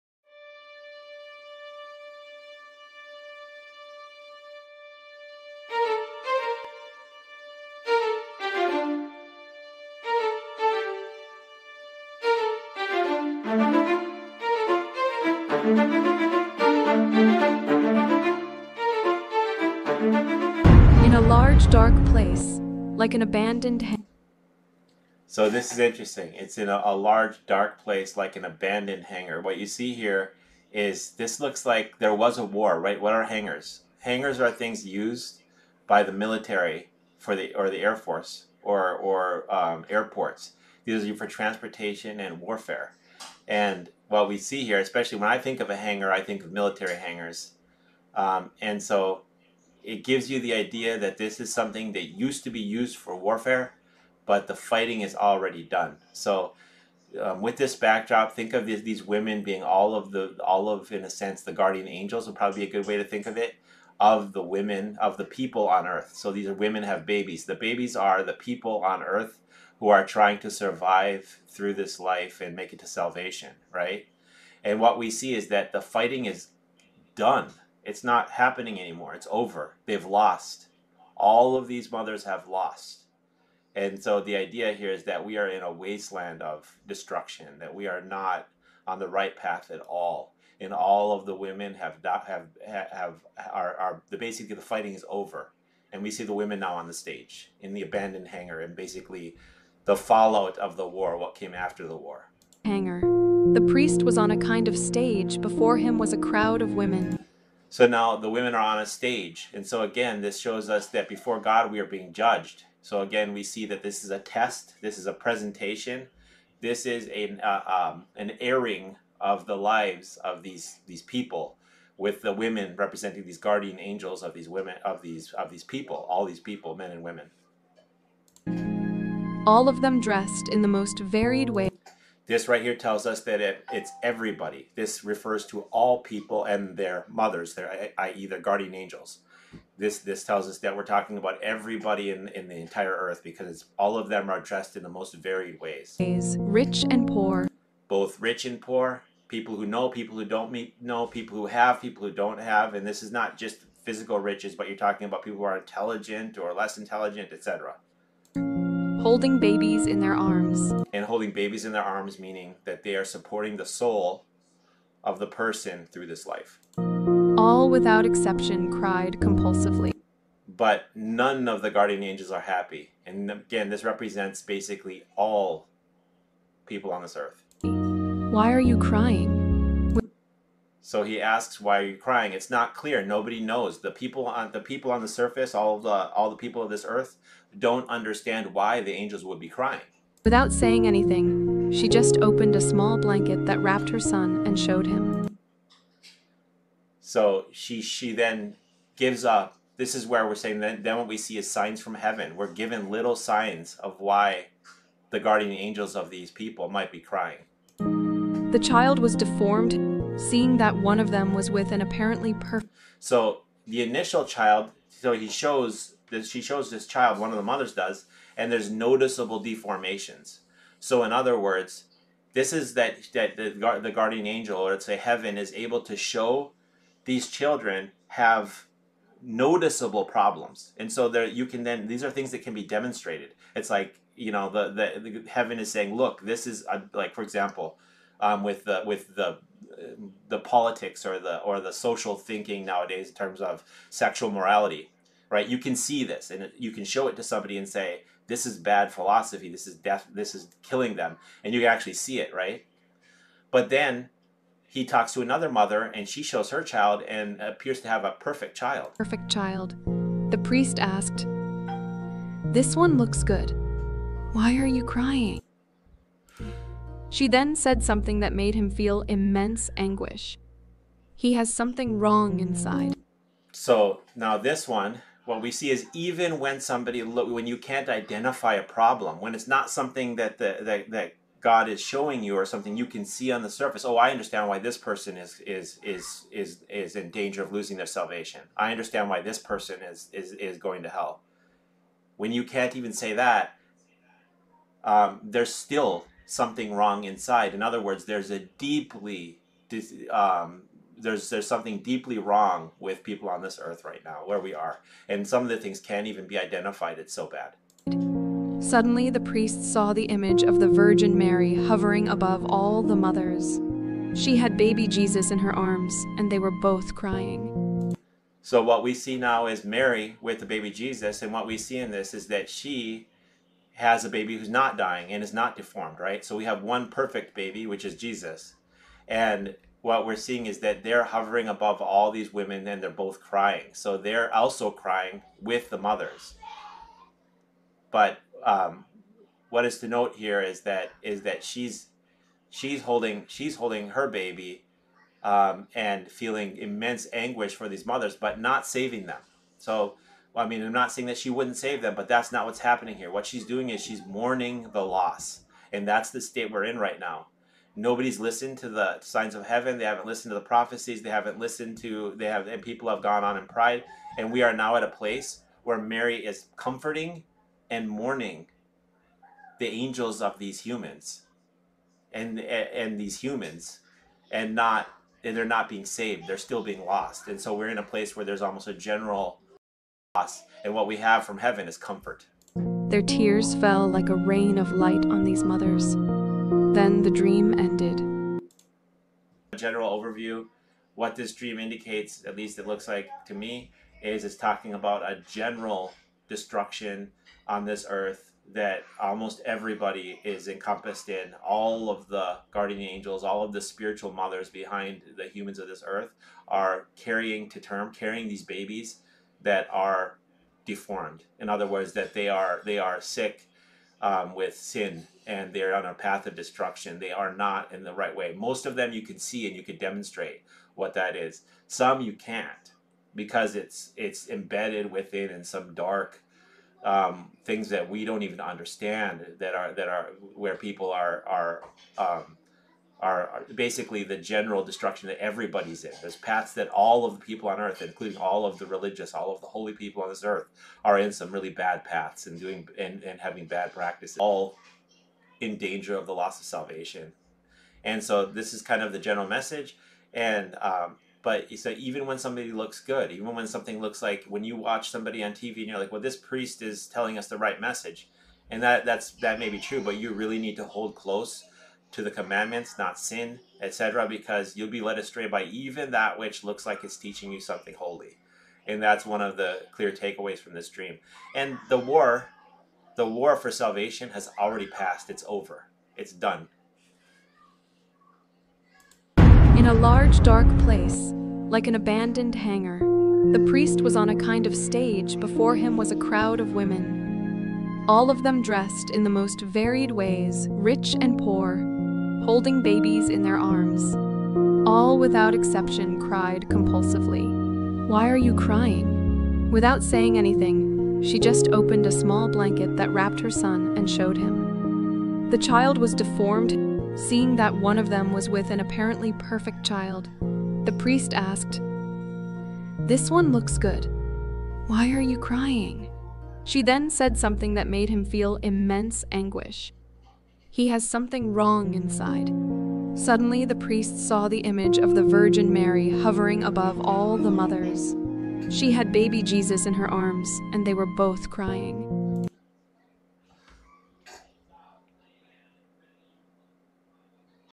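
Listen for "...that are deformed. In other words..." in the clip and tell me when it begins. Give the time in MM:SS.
06:49.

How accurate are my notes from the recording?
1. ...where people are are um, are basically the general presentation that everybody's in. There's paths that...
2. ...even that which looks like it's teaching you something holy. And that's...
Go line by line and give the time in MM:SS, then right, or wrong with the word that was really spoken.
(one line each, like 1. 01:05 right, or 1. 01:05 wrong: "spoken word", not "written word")
1. 07:10 wrong: "destruction", not "presentation"
2. 07:45 right.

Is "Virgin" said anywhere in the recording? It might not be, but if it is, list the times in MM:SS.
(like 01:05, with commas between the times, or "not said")
05:10, 08:45.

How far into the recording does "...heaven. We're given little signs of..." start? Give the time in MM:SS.
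03:21.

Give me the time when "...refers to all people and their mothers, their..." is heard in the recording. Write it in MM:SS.
02:15.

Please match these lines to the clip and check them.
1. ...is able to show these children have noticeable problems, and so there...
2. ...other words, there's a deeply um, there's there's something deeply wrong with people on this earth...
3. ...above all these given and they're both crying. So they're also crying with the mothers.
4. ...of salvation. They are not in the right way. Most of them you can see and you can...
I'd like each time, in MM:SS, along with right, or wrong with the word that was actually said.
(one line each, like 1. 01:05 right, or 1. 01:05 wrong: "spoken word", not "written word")
1. 03:45 right
2. 04:57 right
3. 05:31 wrong: "women", not "given"
4. 06:56 wrong: "destruction", not "salvation".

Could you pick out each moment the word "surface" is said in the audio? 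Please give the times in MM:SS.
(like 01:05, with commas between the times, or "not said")
03:05, 04:43.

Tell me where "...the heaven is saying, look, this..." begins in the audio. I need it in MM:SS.
03:55.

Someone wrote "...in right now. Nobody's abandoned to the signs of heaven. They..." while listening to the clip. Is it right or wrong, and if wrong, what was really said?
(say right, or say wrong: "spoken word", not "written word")
wrong: "listened", not "abandoned".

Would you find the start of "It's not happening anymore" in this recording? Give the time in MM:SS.
01:17.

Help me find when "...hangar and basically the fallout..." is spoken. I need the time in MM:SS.
01:38.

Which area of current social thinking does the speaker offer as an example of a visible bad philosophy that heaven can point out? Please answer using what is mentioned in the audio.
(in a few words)
Sexual morality.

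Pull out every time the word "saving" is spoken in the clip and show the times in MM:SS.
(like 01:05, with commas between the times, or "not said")
05:48.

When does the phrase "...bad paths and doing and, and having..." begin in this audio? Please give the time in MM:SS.
07:21.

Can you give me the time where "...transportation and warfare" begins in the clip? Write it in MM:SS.
00:41.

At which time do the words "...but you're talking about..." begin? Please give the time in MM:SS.
02:34.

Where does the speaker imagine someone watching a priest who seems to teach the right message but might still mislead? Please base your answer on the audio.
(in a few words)
On TV.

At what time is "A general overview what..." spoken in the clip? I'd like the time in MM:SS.
06:29.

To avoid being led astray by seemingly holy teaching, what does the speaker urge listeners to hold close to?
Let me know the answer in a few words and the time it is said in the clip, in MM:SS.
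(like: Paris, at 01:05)
The commandments, at 07:42.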